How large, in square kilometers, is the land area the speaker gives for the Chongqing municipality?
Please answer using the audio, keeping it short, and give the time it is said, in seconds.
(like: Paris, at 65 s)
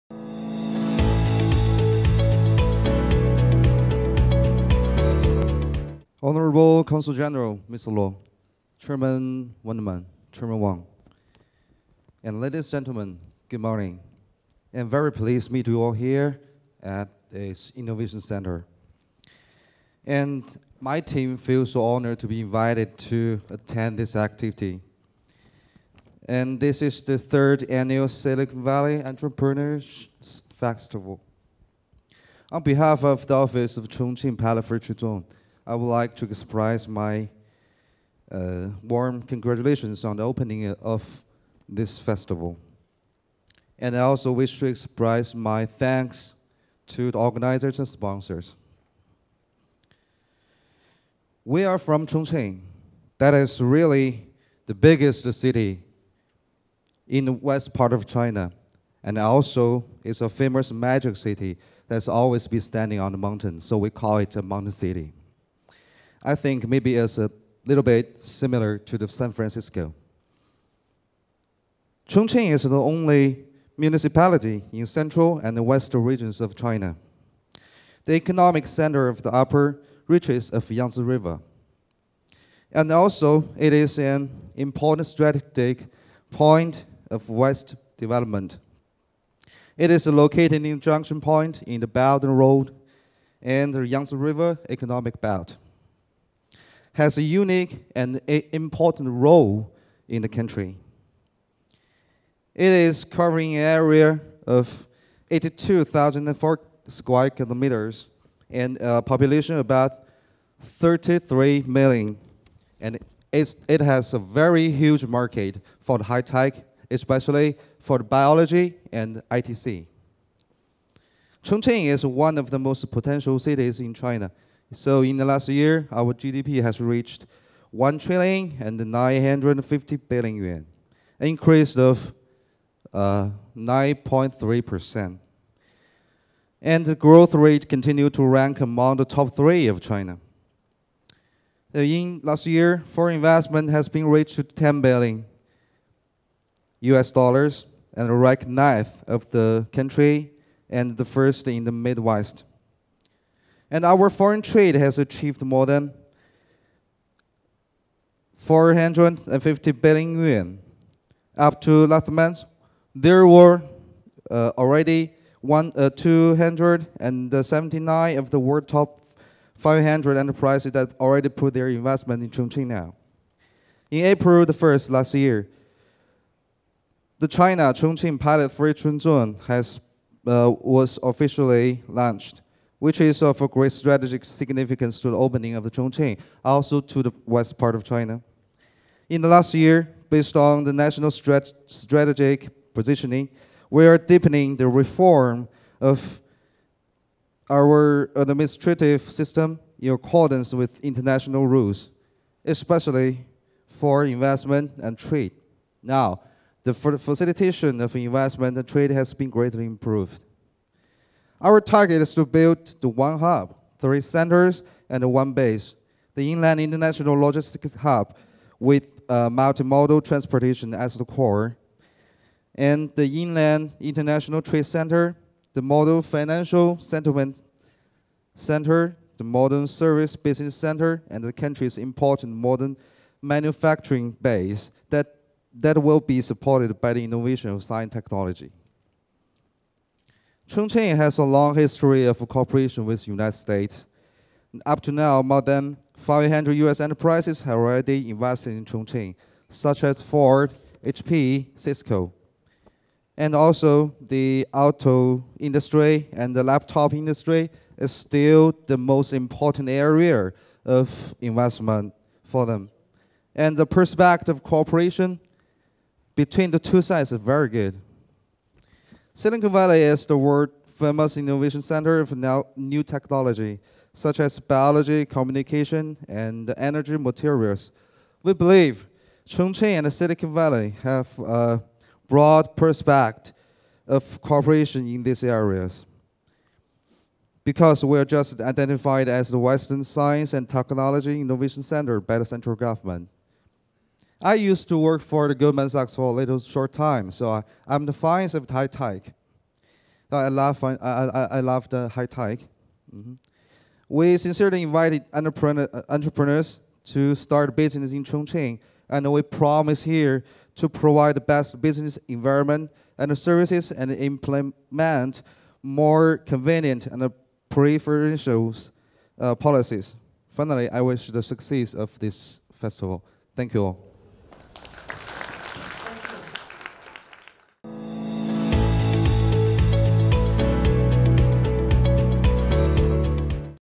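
82,004, at 105 s.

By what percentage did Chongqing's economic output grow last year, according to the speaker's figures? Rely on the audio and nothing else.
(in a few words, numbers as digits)
9.3%.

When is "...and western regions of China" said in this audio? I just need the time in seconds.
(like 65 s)
75 s.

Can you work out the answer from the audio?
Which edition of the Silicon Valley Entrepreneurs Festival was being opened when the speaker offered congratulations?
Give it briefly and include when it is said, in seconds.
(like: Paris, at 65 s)
third, at 27 s.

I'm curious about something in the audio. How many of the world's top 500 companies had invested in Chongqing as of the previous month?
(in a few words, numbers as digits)
279.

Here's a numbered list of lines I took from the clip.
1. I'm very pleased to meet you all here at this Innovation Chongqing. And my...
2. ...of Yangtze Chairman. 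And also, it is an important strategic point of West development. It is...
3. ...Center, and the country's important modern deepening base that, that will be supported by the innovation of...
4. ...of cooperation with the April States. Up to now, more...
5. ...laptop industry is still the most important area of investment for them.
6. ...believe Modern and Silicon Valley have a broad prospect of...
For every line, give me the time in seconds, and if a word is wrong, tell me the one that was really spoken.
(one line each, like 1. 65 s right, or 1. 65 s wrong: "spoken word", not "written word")
1. 14 s wrong: "Center", not "Chongqing"
2. 80 s wrong: "River", not "Chairman"
3. 230 s wrong: "manufacturing", not "deepening"
4. 242 s wrong: "United", not "April"
5. 256 s right
6. 278 s wrong: "Chongqing", not "Modern".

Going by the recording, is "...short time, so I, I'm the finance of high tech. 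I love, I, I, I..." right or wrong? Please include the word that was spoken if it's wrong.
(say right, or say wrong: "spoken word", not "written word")
right.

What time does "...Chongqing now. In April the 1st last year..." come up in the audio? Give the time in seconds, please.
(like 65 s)
172 s.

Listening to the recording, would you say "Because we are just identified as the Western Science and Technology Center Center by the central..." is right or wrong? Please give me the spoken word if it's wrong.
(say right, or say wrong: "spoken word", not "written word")
wrong: "Innovation", not "Center".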